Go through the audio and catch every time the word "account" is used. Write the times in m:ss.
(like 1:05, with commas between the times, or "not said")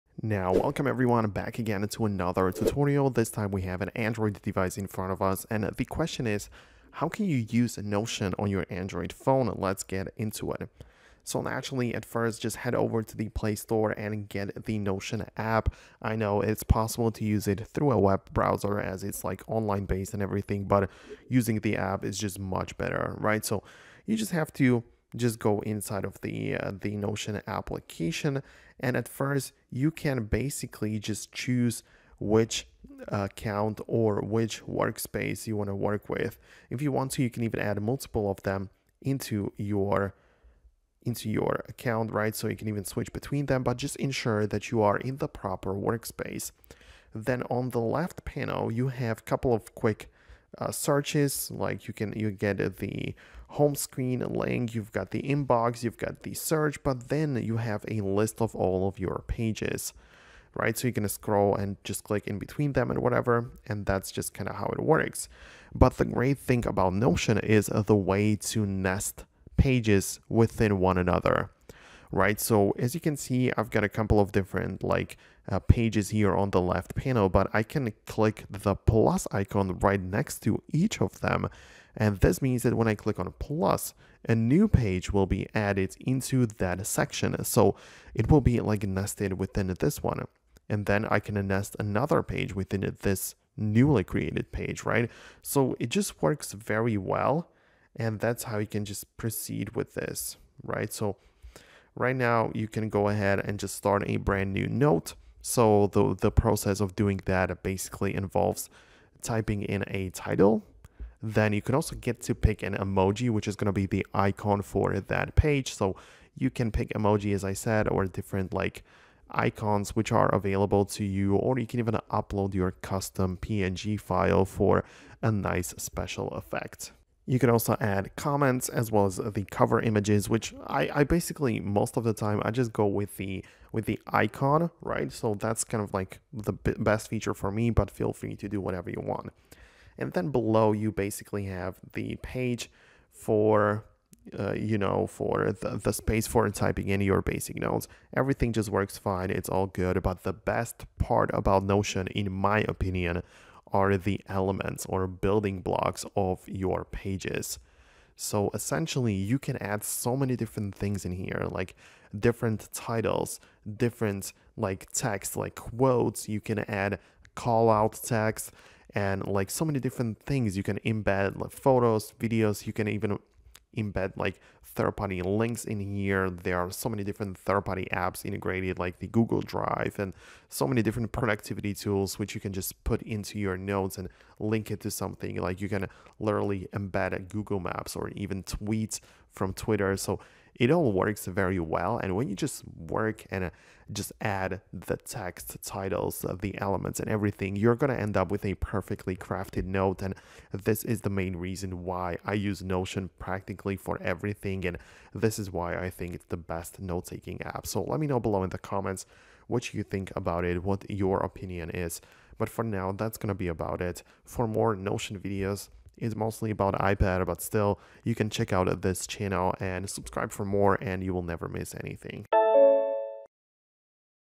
0:33, 0:41.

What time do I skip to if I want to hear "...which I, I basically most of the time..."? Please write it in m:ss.
2:10.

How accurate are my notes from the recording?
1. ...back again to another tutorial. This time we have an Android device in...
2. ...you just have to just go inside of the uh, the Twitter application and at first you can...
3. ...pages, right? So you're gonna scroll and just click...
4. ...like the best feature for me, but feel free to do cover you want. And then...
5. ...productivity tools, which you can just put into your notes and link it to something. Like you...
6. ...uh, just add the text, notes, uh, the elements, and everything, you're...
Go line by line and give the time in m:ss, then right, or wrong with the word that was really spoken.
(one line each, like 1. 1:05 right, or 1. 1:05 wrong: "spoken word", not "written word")
1. 0:01 right
2. 0:24 wrong: "Notion", not "Twitter"
3. 0:59 right
4. 2:15 wrong: "whatever", not "cover"
5. 3:01 right
6. 3:13 wrong: "titles", not "notes".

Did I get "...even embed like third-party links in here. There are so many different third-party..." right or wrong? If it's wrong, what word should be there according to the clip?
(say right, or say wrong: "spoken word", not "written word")
right.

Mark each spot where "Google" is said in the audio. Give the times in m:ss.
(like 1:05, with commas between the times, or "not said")
2:59, 3:07.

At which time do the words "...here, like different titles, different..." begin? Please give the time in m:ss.
2:41.